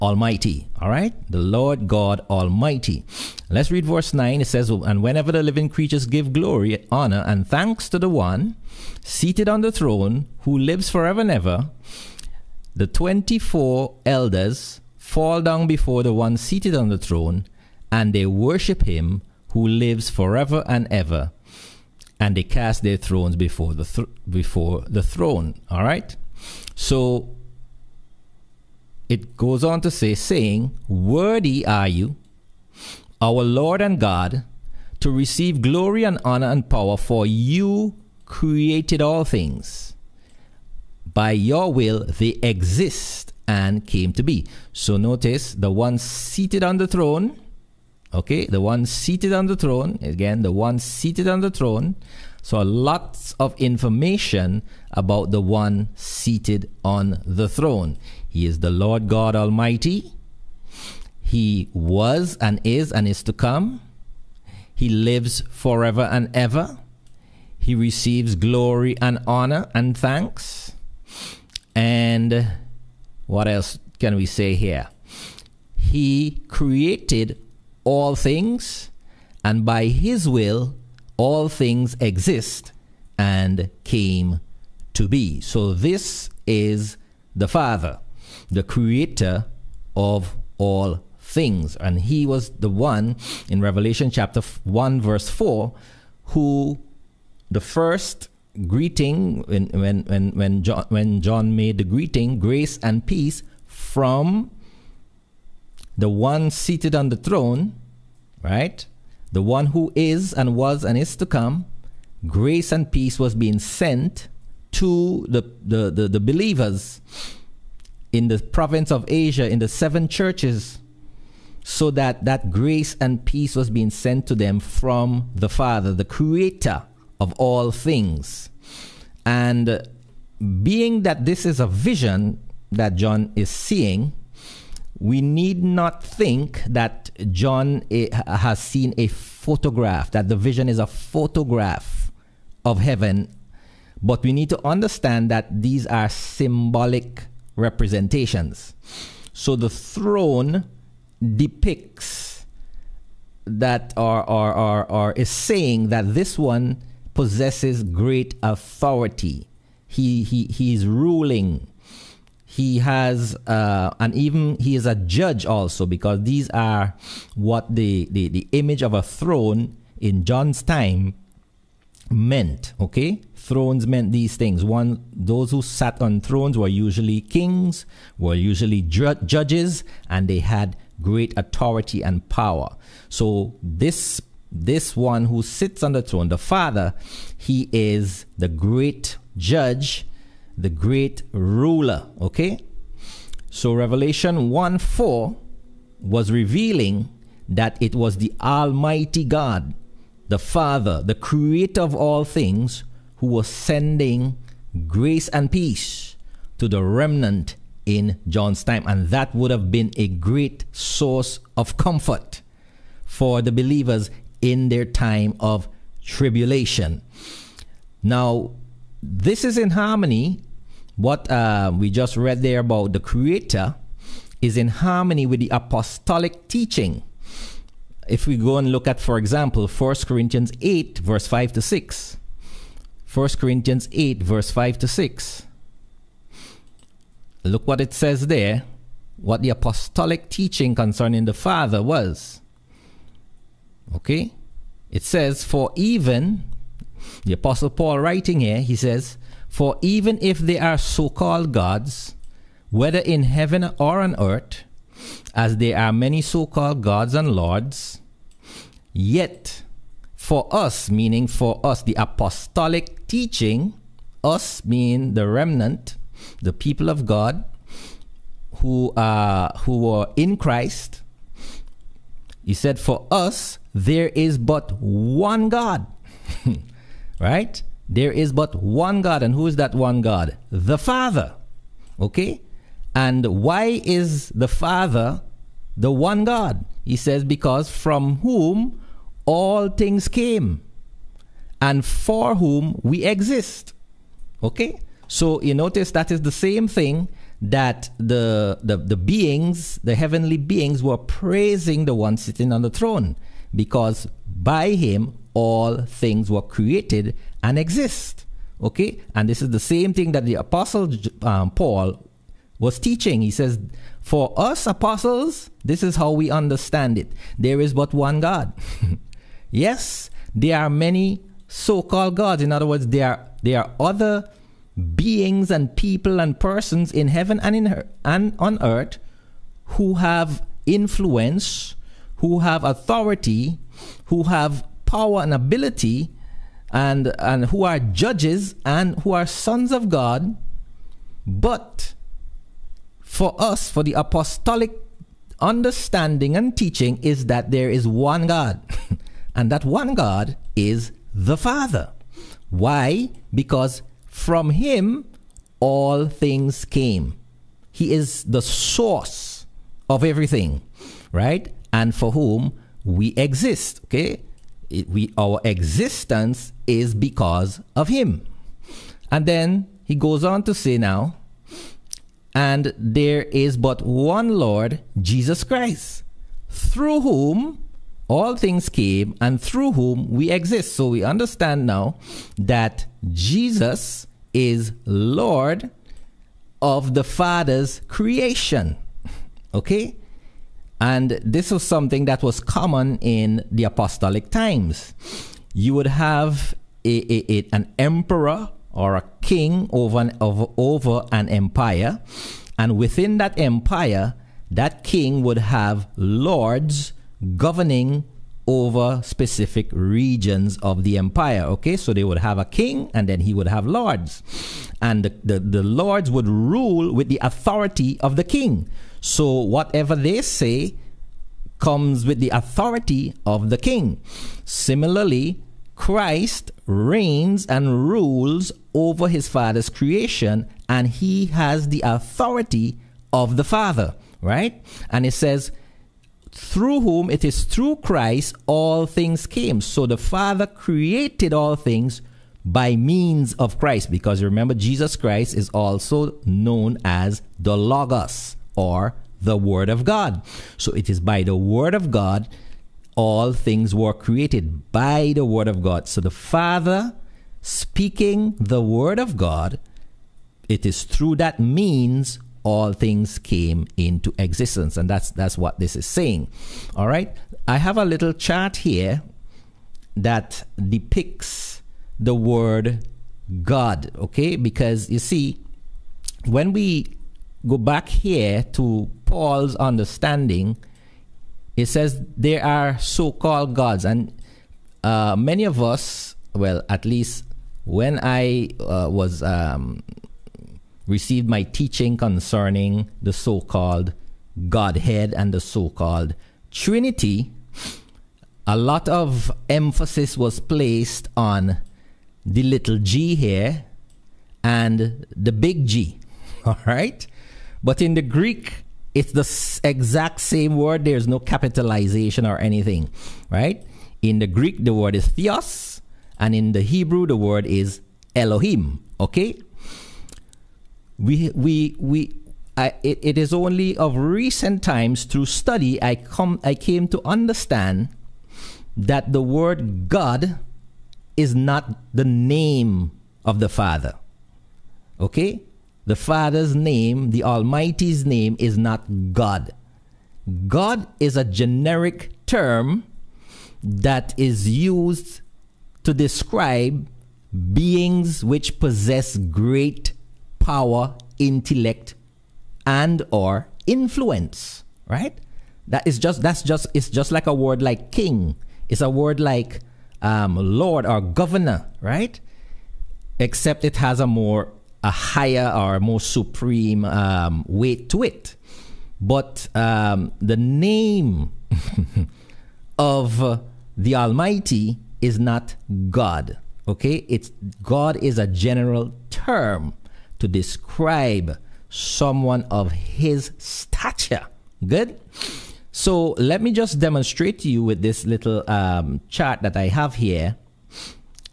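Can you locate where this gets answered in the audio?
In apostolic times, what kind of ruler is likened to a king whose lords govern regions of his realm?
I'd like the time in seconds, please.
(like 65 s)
397 s.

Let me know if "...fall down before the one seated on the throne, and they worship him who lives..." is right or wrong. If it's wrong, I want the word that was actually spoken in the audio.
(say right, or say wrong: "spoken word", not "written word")
right.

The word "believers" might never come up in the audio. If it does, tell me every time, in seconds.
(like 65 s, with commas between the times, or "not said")
116 s, 213 s.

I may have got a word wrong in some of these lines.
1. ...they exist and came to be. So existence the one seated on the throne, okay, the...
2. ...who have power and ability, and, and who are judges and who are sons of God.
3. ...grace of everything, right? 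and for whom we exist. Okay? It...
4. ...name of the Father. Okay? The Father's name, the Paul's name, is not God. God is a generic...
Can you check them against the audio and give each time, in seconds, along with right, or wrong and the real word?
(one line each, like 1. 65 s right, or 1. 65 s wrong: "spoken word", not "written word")
1. 42 s wrong: "notice", not "existence"
2. 334 s right
3. 358 s wrong: "source", not "grace"
4. 532 s wrong: "Almighty", not "Paul".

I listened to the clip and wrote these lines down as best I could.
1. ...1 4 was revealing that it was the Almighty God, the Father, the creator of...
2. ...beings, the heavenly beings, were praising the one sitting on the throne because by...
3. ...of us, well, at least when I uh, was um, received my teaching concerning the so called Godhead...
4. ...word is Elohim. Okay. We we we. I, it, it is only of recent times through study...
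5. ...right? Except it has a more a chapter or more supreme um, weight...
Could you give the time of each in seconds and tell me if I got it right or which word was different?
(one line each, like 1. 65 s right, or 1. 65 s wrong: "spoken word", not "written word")
1. 194 s right
2. 298 s right
3. 485 s right
4. 517 s right
5. 561 s wrong: "higher", not "chapter".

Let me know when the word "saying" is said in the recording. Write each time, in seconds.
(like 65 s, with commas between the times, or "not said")
30 s, 155 s, 465 s.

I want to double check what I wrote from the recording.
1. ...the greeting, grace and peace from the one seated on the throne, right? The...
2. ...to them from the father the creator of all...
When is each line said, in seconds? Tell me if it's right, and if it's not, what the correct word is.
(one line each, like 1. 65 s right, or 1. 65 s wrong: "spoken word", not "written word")
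1. 101 s right
2. 124 s right.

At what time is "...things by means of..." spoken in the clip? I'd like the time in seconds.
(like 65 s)
441 s.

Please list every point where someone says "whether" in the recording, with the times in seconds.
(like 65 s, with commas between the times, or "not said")
252 s.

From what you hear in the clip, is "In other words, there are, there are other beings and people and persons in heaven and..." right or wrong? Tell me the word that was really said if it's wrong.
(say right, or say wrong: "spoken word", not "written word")
right.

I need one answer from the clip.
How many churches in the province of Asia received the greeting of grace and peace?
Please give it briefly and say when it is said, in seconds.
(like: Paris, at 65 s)
7, at 119 s.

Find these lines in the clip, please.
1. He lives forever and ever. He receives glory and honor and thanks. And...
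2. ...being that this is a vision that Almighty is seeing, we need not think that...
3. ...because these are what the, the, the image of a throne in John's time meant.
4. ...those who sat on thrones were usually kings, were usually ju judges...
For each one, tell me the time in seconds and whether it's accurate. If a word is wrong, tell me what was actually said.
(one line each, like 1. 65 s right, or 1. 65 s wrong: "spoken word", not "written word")
1. 64 s right
2. 130 s wrong: "John", not "Almighty"
3. 165 s right
4. 175 s right.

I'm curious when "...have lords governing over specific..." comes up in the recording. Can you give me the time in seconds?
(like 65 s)
405 s.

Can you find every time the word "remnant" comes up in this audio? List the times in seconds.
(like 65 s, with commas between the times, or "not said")
206 s, 265 s.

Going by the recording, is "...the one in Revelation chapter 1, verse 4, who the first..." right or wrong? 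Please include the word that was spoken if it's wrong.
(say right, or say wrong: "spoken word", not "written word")
right.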